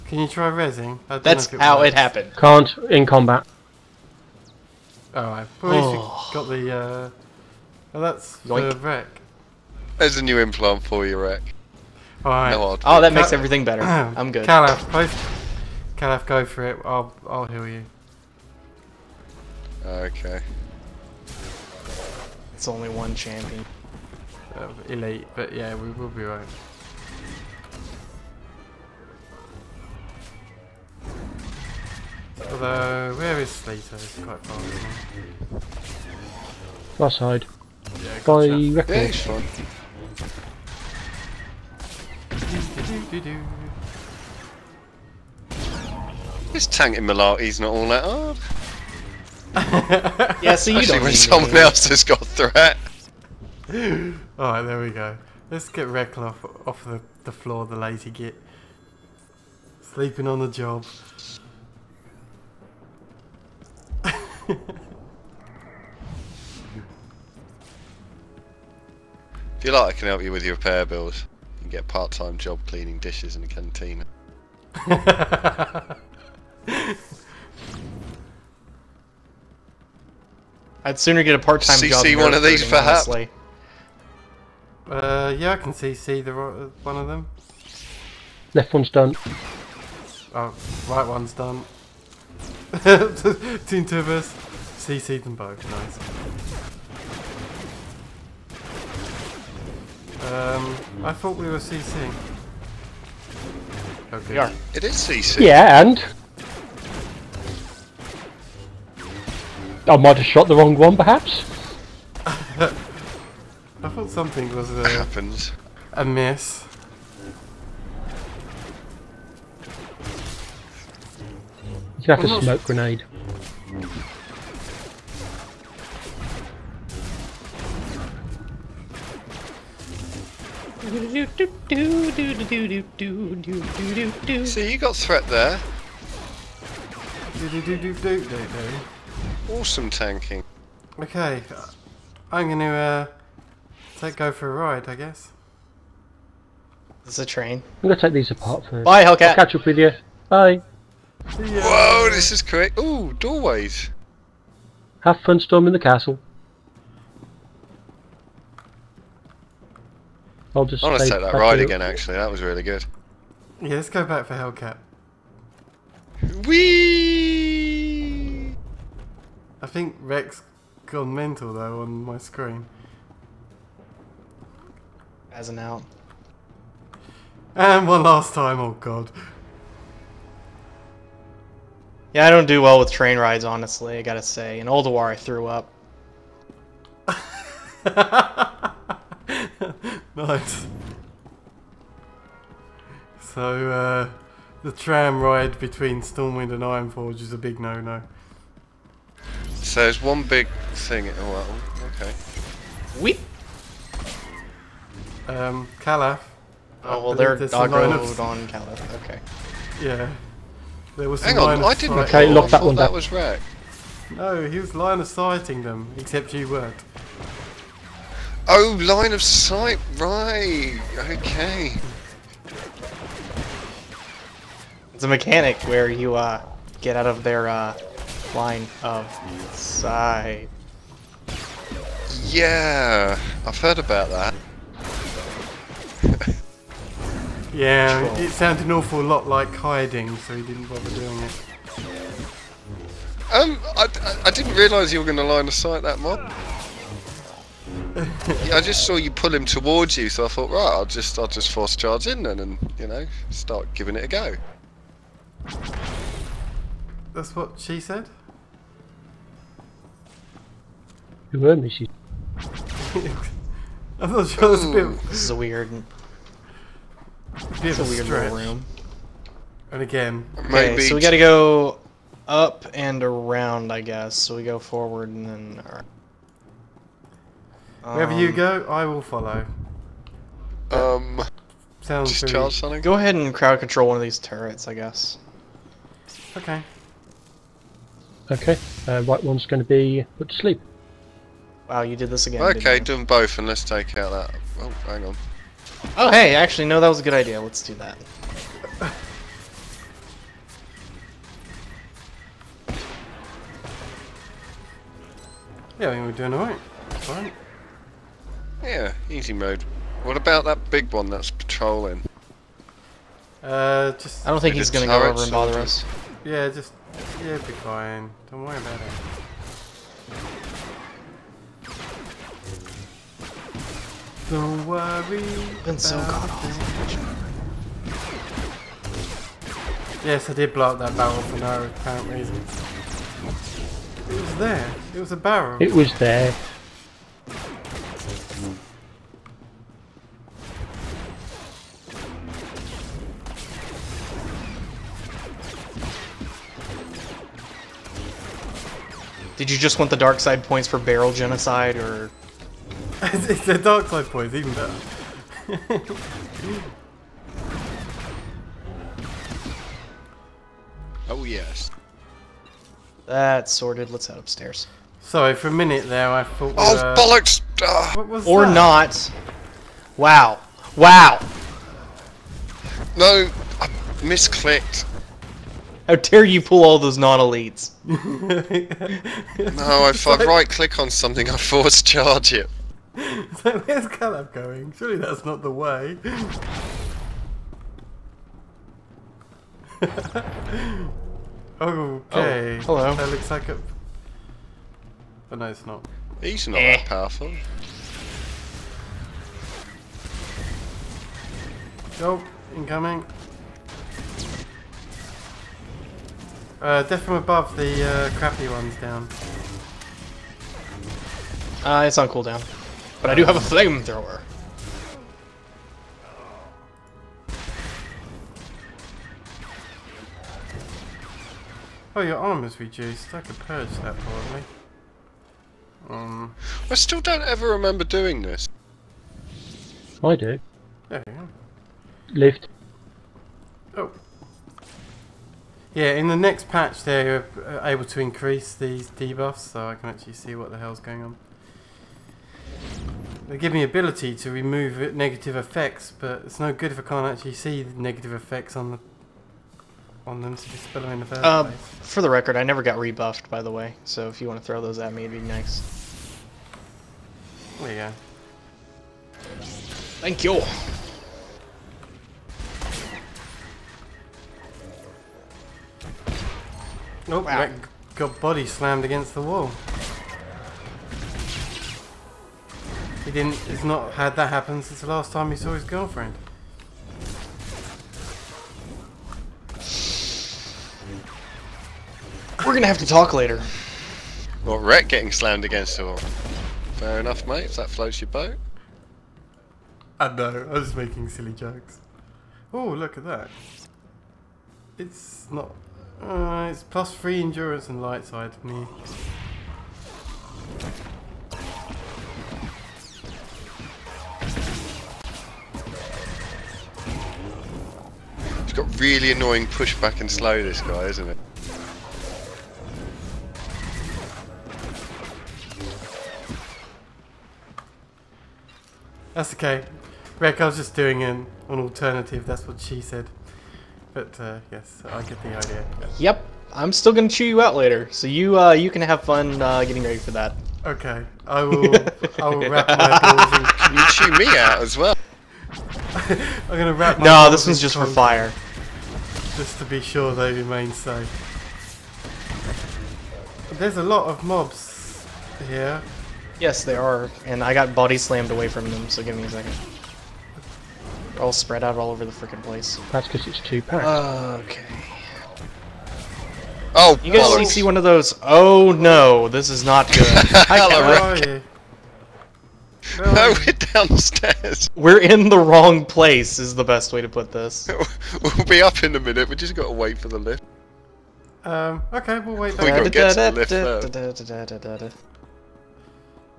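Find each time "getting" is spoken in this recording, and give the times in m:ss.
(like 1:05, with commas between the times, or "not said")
8:04, 8:49.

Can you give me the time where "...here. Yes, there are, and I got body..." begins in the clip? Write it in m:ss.
9:05.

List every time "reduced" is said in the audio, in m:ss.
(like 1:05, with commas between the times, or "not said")
7:02.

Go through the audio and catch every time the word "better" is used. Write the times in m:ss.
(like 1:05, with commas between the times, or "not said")
0:13, 5:54.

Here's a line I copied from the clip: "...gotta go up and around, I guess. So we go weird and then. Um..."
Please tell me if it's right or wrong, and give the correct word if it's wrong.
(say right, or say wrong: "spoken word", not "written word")
wrong: "forward", not "weird".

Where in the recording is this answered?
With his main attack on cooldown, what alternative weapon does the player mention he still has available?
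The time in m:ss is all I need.
6:53.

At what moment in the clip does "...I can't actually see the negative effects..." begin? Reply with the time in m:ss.
7:26.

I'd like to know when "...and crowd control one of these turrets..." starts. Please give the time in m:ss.
4:43.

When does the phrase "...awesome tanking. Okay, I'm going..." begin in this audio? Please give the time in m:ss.
2:19.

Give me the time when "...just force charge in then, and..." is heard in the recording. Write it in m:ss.
4:11.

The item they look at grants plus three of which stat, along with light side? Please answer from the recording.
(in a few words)
Endurance.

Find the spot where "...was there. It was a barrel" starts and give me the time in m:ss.
5:34.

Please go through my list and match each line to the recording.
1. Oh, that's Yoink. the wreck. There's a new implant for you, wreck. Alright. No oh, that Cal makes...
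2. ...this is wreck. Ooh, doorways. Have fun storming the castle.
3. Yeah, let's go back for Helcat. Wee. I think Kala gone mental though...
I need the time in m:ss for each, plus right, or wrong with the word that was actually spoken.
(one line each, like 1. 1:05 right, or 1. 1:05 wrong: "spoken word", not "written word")
1. 0:07 right
2. 2:32 wrong: "quick", not "wreck"
3. 2:43 wrong: "Rex", not "Kala".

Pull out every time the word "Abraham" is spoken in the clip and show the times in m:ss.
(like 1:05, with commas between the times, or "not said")
not said.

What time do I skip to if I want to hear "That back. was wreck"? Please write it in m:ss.
3:32.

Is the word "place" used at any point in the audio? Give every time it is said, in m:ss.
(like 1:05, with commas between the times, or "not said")
7:31, 9:12, 9:25.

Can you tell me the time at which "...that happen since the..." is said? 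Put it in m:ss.
7:54.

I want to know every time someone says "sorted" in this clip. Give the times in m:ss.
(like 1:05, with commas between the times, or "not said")
6:03.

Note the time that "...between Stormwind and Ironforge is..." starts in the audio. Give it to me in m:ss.
3:15.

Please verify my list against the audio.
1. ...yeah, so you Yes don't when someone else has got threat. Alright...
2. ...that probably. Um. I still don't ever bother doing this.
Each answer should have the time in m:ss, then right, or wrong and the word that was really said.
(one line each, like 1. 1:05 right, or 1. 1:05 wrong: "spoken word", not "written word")
1. 0:49 wrong: "Especially", not "Yes"
2. 7:03 wrong: "remember", not "bother".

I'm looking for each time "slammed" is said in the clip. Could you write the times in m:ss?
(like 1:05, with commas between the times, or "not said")
7:48, 8:05, 9:07.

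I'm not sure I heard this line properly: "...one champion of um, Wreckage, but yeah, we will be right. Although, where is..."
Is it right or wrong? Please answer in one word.
wrong.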